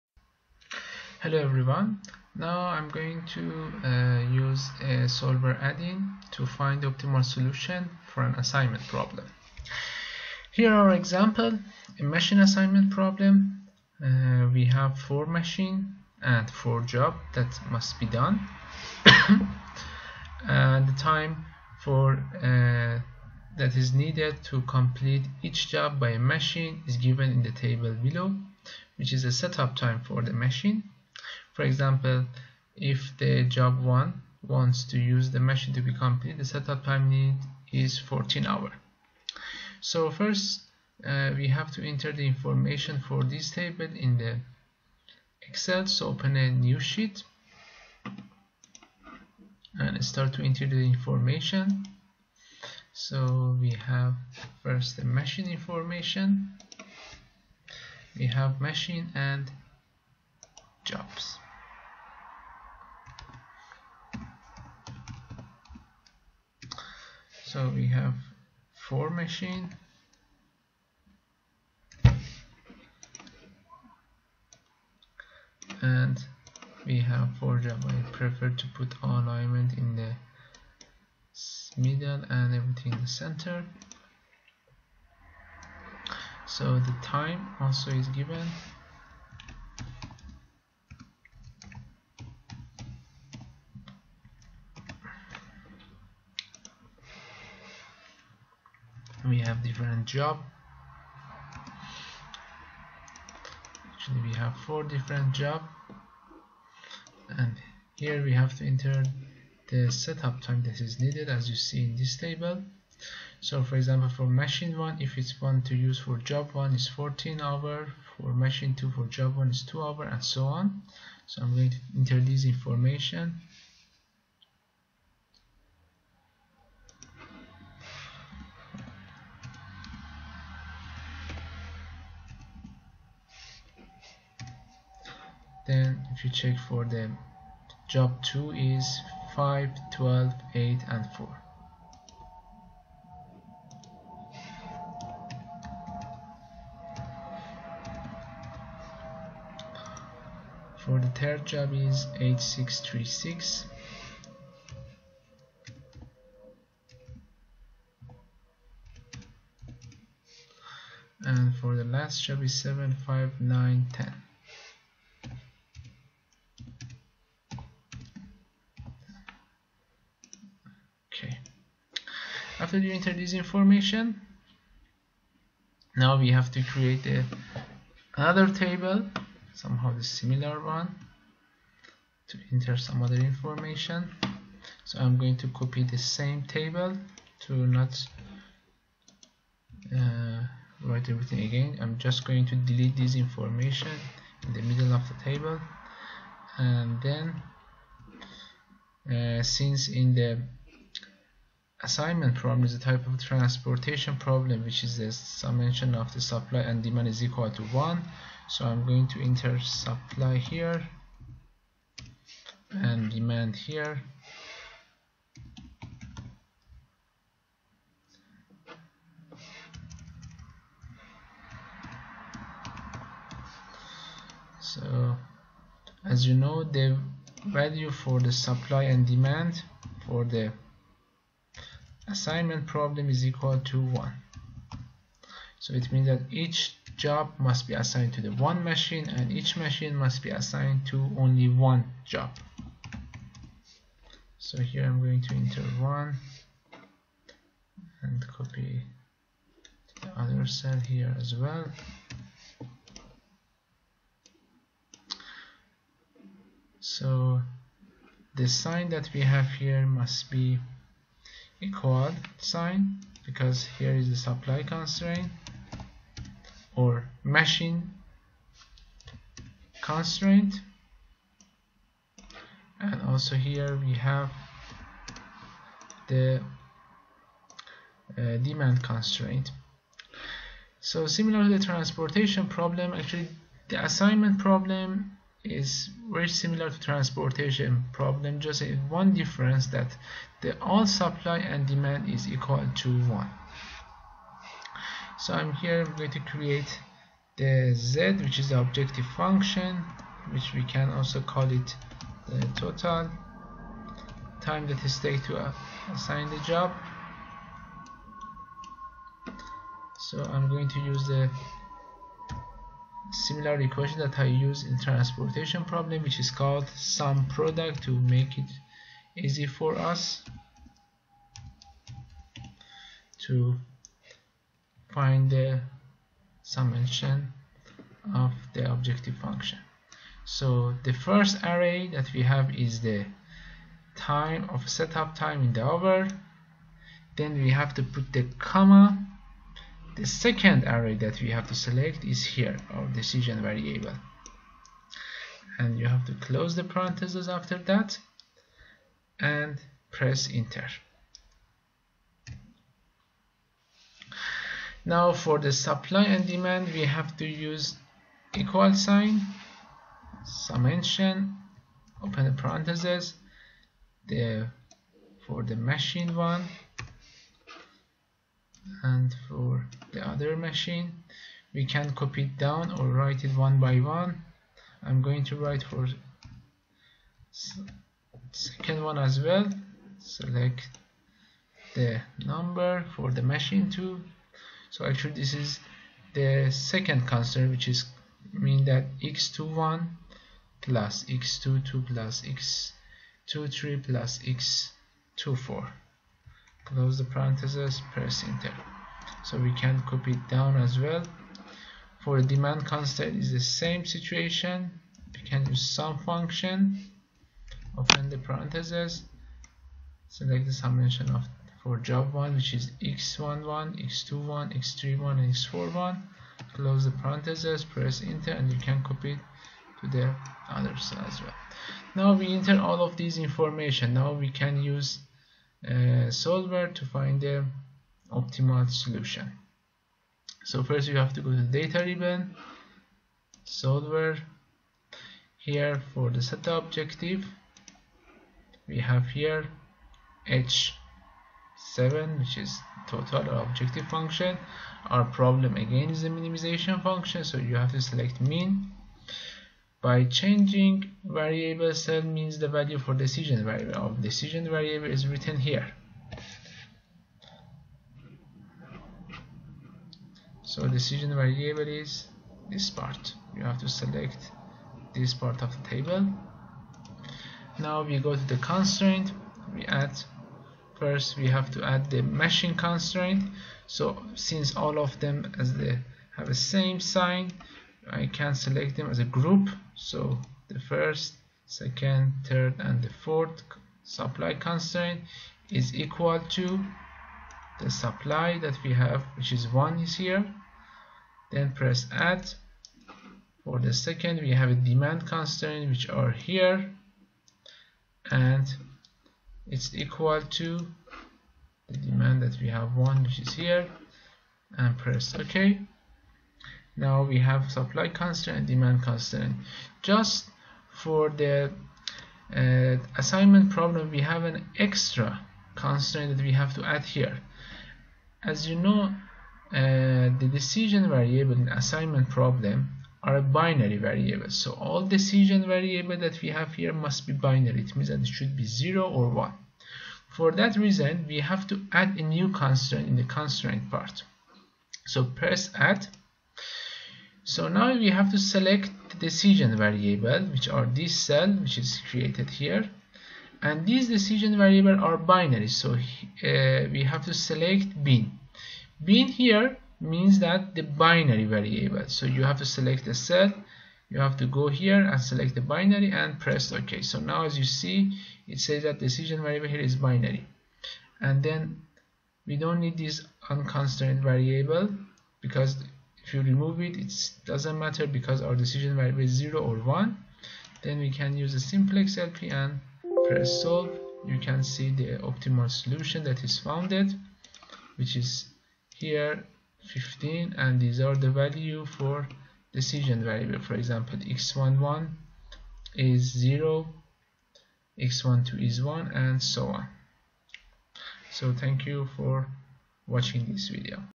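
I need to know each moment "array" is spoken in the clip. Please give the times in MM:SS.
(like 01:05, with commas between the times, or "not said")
05:31, 05:40.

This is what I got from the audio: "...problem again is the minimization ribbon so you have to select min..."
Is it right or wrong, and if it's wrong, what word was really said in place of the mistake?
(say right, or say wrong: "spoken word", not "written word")
wrong: "function", not "ribbon".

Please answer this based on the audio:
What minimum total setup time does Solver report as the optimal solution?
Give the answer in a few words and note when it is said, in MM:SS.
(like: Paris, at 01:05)
15, at 09:39.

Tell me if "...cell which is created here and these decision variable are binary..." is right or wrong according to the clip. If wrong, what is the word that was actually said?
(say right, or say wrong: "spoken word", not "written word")
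right.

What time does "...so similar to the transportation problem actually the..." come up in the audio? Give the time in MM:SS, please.
04:40.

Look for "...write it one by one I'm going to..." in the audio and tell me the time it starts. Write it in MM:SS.
06:12.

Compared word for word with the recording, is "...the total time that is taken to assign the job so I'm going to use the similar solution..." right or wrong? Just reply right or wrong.
wrong.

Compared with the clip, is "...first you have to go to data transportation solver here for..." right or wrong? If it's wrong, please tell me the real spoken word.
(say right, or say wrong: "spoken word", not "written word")
wrong: "ribbon", not "transportation".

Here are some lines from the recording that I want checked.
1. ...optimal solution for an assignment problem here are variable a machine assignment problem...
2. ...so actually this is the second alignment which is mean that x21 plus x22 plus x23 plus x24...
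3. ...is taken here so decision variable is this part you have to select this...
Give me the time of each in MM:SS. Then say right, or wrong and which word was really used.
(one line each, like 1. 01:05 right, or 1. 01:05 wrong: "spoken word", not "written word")
1. 00:06 wrong: "example", not "variable"
2. 06:24 wrong: "constant", not "alignment"
3. 07:34 wrong: "written", not "taken".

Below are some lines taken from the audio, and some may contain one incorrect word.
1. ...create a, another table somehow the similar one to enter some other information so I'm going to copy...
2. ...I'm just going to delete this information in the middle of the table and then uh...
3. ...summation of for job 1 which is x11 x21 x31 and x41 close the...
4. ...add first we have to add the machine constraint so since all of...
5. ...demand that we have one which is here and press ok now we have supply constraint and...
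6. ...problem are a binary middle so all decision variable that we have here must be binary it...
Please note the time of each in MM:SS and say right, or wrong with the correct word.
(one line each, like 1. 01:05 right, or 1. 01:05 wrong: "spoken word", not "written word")
1. 02:56 right
2. 03:11 right
3. 06:50 right
4. 07:49 right
5. 08:21 right
6. 08:42 wrong: "variable", not "middle".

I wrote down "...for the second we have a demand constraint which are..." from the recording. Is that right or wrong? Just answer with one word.
right.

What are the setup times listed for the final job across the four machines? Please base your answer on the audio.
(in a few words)
7, 5, 9, 10.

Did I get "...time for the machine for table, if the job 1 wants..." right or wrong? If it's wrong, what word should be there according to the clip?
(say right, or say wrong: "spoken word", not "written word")
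wrong: "example", not "table".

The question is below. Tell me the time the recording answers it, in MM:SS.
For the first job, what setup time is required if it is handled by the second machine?
01:59.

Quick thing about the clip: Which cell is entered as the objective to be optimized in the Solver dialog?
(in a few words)
H7.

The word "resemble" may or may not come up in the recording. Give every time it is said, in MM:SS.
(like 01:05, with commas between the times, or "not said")
not said.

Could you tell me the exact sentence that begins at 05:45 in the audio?
And you have to close the parentheses after that and press enter.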